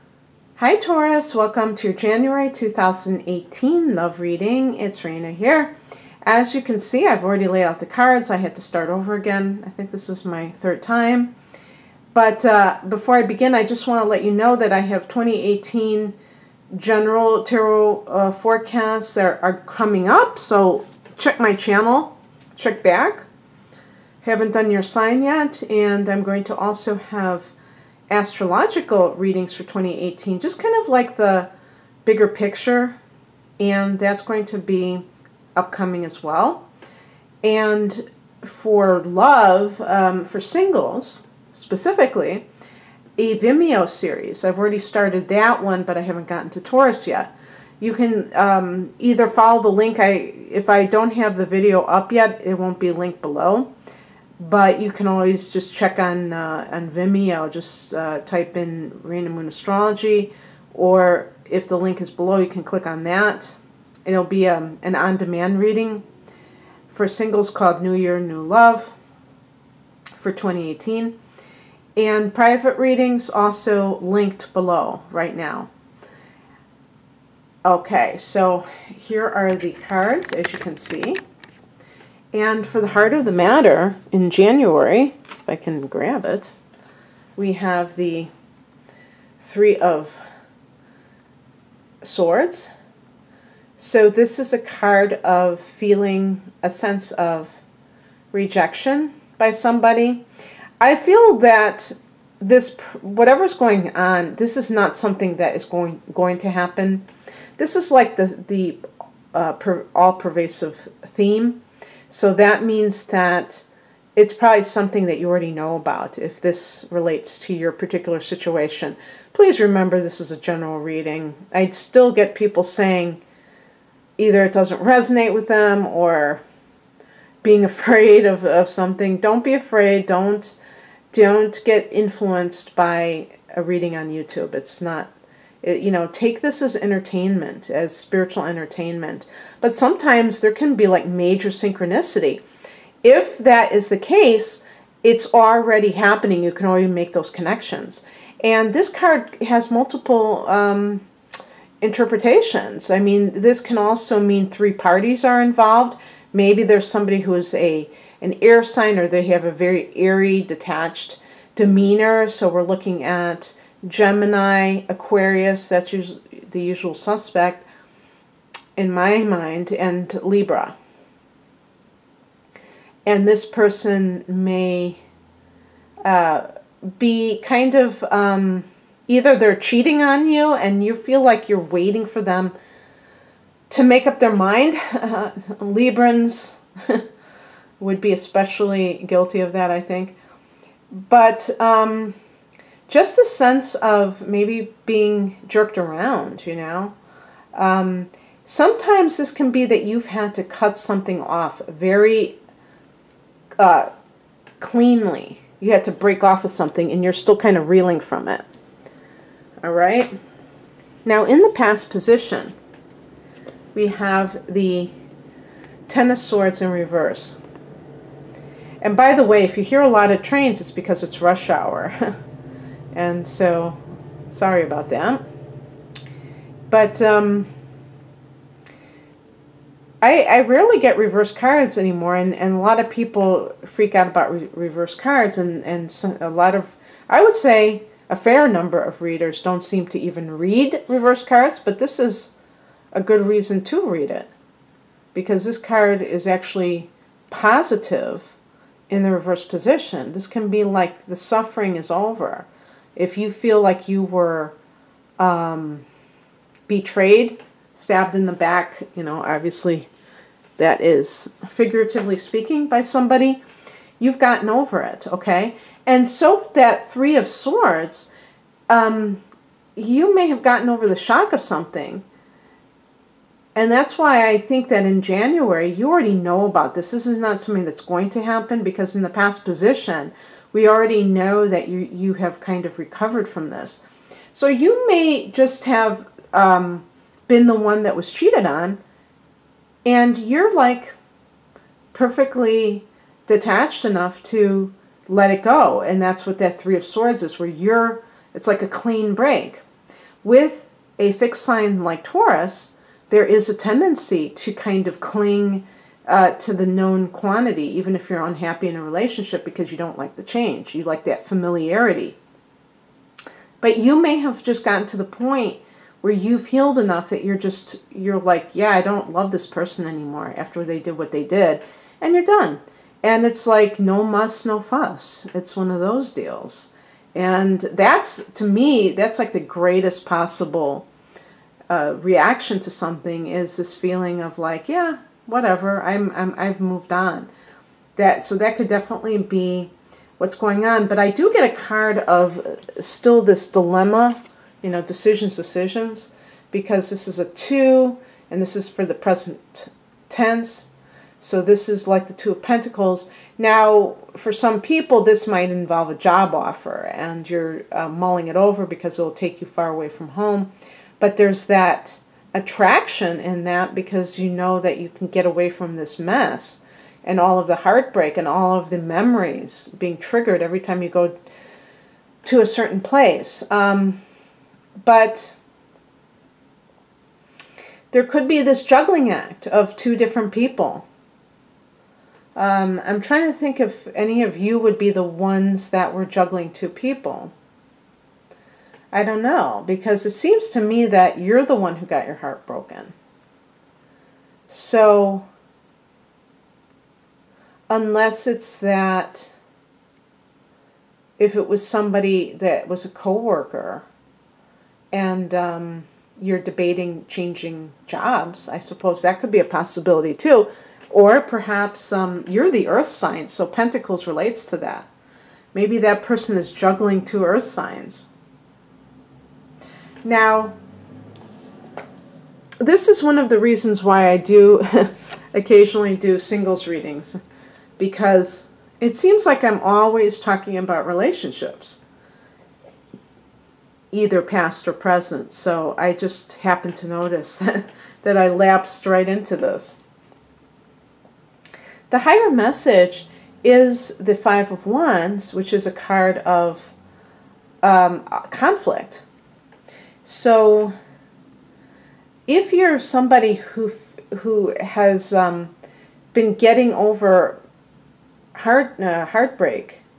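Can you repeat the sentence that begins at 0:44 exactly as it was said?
I've already started that one, but I haven't gotten to Taurus yet.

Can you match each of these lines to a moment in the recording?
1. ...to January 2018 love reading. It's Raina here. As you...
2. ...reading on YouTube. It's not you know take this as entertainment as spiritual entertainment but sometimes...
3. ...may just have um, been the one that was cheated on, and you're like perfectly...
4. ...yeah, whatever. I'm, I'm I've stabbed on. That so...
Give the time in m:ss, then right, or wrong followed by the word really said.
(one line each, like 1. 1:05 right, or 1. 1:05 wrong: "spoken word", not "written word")
1. 0:01 right
2. 2:13 right
3. 4:44 right
4. 5:34 wrong: "moved", not "stabbed".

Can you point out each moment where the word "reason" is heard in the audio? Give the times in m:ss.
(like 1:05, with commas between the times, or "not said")
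4:03, 7:03.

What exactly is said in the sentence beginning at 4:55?
And that's what that Three of Swords is, where you're, it's like a clean break.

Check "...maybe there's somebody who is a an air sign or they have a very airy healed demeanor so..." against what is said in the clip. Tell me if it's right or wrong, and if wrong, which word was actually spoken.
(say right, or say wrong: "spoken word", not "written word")
wrong: "detached", not "healed".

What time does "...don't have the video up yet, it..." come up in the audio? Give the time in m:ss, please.
0:50.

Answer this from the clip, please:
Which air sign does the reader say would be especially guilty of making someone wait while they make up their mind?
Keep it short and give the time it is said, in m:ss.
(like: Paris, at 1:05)
Libra, at 3:05.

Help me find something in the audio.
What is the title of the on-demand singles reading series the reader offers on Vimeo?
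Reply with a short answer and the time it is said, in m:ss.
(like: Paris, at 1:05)
New Year, New Love, at 1:07.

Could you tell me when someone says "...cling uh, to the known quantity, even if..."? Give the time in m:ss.
5:05.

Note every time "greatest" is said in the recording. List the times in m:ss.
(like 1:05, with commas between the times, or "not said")
5:29.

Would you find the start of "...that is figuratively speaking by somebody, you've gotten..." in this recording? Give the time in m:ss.
4:20.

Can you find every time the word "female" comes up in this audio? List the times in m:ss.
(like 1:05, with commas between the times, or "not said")
not said.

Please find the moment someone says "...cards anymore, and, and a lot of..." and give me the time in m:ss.
3:51.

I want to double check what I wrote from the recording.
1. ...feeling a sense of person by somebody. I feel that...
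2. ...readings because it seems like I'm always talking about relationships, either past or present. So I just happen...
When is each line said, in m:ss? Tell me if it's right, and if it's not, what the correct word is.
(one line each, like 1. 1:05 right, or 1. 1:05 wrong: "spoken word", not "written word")
1. 1:35 wrong: "rejection", not "person"
2. 7:06 right.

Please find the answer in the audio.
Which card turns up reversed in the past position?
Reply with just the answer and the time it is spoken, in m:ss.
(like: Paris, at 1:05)
Ten of Swords, at 3:35.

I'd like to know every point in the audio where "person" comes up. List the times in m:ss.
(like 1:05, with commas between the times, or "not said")
2:53, 5:19, 6:56.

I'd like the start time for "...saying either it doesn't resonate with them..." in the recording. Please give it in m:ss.
2:02.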